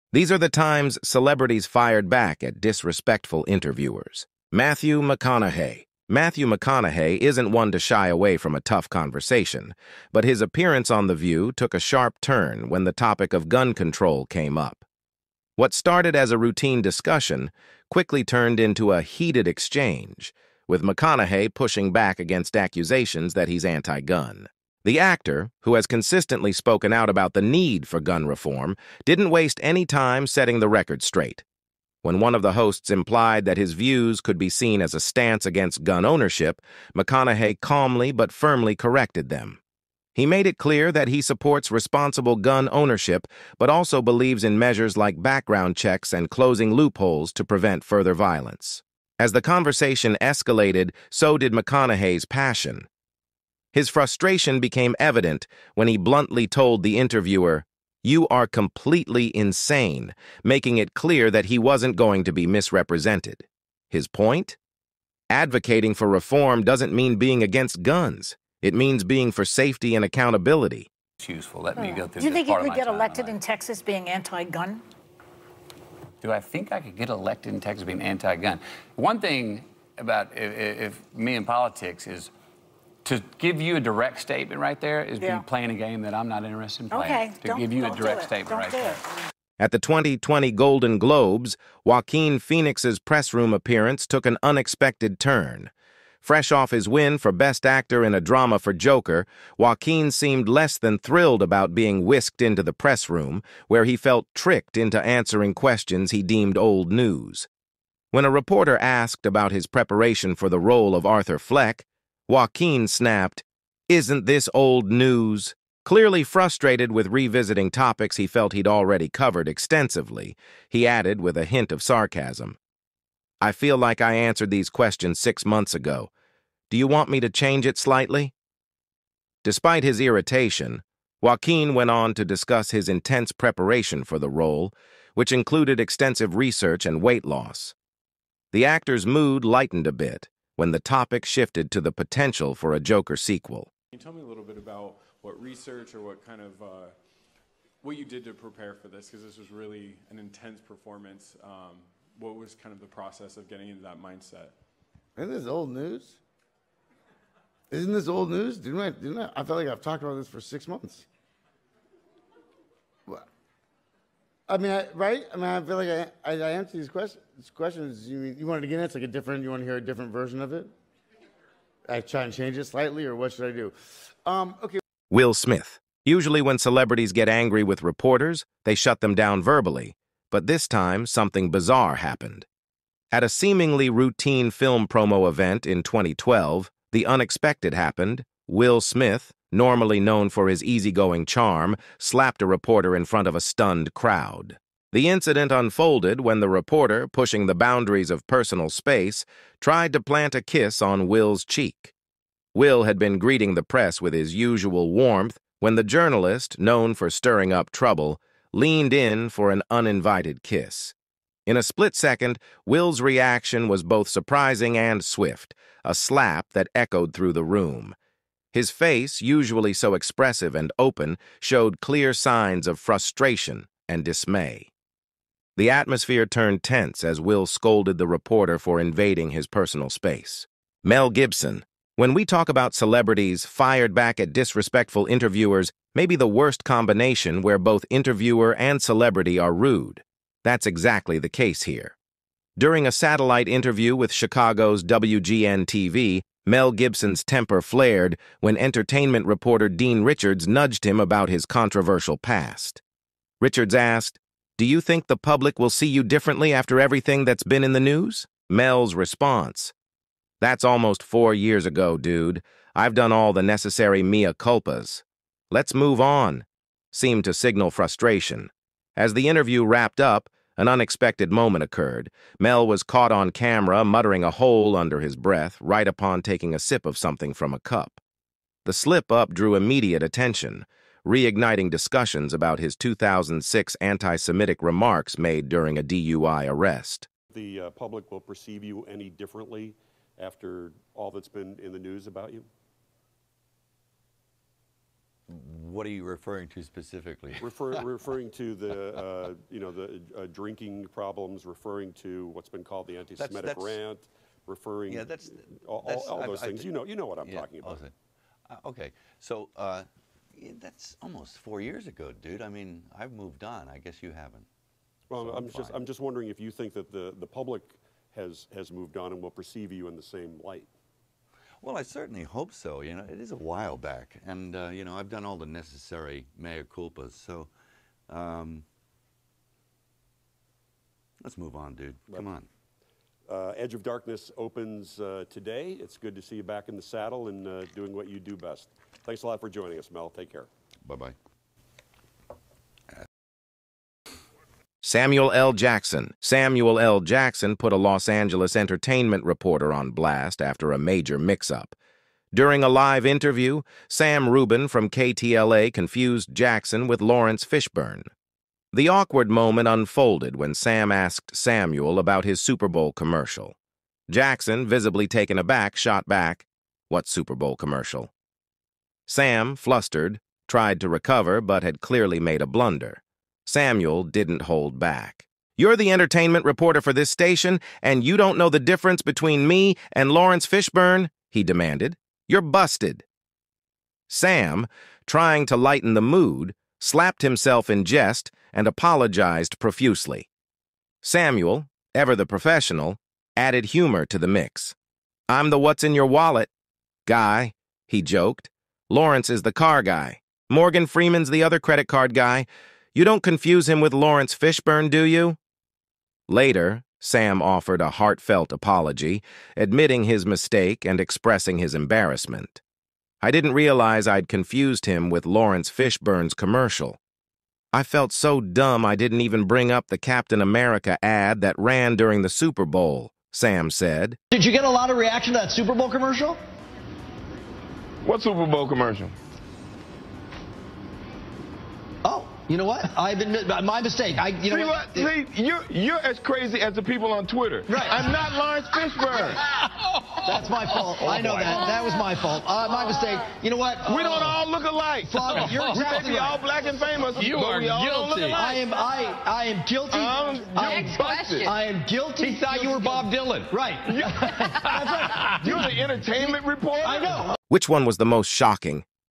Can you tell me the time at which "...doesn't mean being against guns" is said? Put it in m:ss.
1:06.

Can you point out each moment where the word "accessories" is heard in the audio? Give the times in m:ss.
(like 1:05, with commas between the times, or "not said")
not said.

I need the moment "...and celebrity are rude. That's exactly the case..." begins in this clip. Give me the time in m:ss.
3:58.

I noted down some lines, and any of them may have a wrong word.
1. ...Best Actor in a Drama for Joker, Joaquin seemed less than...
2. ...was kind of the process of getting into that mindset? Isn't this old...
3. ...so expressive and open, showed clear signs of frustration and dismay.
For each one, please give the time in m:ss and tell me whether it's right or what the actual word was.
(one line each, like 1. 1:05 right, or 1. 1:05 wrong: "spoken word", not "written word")
1. 1:37 right
2. 2:32 right
3. 3:39 right.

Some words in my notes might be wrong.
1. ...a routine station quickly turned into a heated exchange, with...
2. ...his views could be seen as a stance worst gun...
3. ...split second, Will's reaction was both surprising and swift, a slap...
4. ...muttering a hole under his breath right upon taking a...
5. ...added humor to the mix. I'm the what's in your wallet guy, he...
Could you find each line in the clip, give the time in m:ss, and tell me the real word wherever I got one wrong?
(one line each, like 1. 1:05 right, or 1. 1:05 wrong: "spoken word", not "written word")
1. 0:16 wrong: "discussion", not "station"
2. 0:33 wrong: "against", not "worst"
3. 3:31 right
4. 4:33 right
5. 6:33 right.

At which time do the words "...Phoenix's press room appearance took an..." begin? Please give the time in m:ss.
1:32.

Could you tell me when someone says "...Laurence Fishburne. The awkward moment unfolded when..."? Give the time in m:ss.
5:56.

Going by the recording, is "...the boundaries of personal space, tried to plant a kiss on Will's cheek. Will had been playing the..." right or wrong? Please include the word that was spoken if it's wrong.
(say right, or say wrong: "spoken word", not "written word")
wrong: "greeting", not "playing".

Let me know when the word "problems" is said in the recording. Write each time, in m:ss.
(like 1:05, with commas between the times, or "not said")
5:00.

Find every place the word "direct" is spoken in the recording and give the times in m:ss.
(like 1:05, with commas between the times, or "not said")
1:23, 1:27.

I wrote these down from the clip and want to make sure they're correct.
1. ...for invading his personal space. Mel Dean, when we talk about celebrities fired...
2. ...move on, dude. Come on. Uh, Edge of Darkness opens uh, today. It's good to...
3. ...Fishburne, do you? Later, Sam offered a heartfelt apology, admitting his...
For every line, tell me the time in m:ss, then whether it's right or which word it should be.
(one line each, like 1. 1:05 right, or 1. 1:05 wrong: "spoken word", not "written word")
1. 3:48 wrong: "Gibson", not "Dean"
2. 5:31 right
3. 6:44 right.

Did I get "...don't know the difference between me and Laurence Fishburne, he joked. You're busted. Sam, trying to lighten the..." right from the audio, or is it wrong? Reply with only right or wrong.
wrong.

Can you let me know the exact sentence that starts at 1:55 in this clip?
Clearly frustrated with revisiting topics he felt he'd already covered extensively, he added with a hint of sarcasm.